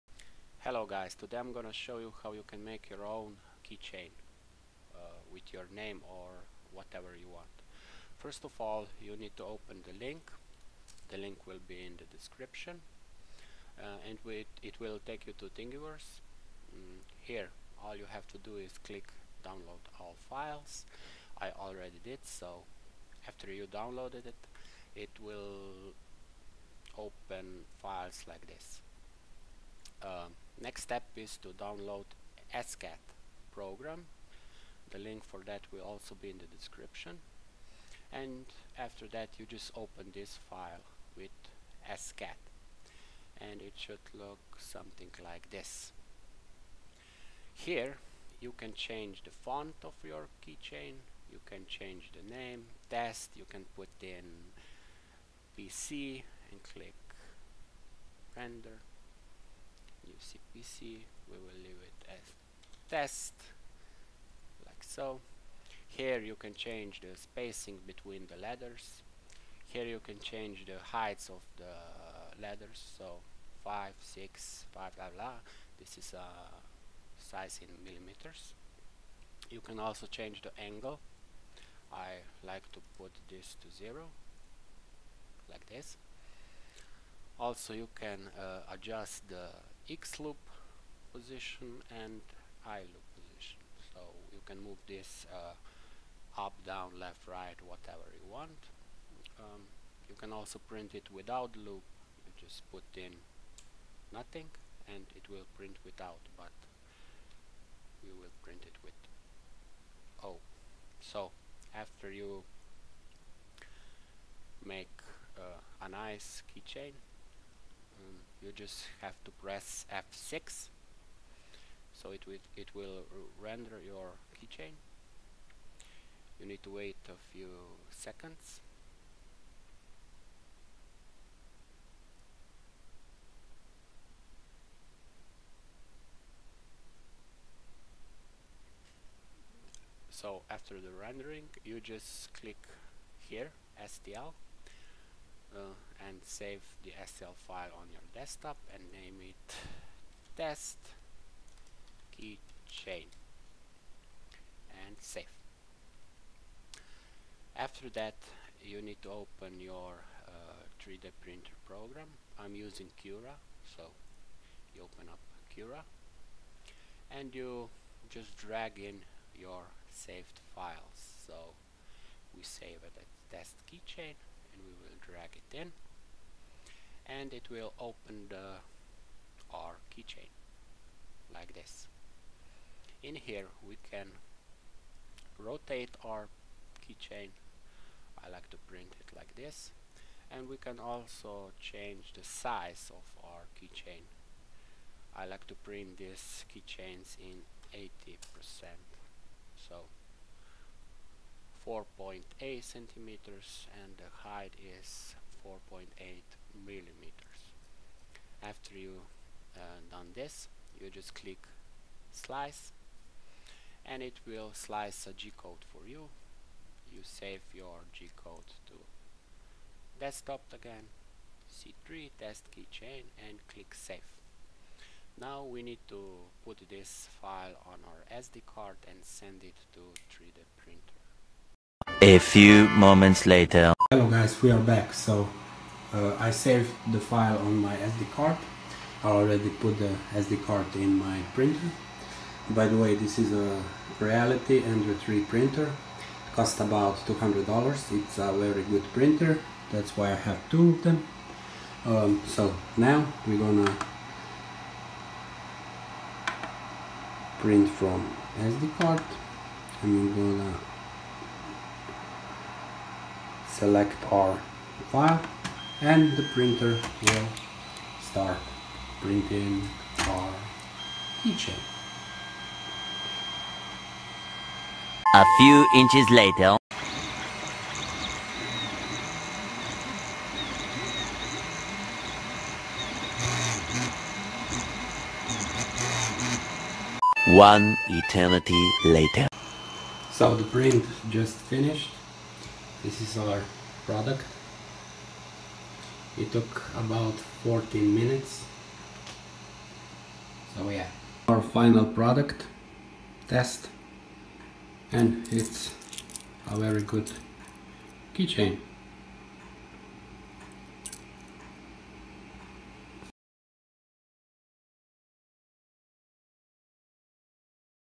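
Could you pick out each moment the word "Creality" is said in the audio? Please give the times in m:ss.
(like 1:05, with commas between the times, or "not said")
4:03.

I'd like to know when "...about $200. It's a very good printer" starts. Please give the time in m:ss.
4:06.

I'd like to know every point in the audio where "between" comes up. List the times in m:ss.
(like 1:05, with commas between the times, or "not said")
1:07.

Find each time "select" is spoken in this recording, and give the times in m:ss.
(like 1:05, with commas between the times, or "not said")
4:23.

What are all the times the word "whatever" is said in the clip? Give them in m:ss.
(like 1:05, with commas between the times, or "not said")
0:06, 1:37.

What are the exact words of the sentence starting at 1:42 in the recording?
You just put in nothing and it will print without, but we will print it with O.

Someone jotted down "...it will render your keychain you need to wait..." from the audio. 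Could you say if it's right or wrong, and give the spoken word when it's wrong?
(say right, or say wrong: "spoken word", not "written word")
right.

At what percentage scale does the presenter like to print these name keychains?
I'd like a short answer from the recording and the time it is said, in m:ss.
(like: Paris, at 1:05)
80 percent, at 3:17.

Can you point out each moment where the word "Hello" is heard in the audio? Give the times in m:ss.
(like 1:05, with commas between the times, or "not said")
0:00, 3:53.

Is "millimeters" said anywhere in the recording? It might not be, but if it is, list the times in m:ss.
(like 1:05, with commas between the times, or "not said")
1:17, 3:26.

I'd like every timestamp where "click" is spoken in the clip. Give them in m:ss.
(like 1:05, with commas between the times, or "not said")
0:18, 0:56, 2:22, 3:31, 3:43.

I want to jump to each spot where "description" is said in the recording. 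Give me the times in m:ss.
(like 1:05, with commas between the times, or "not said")
0:12, 0:36.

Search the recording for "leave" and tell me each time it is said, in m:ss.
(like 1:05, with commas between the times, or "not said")
1:01.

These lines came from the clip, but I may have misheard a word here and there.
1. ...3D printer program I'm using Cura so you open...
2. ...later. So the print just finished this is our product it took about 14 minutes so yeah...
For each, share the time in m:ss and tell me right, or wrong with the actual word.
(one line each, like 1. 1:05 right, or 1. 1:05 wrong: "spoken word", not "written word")
1. 2:40 right
2. 4:48 right.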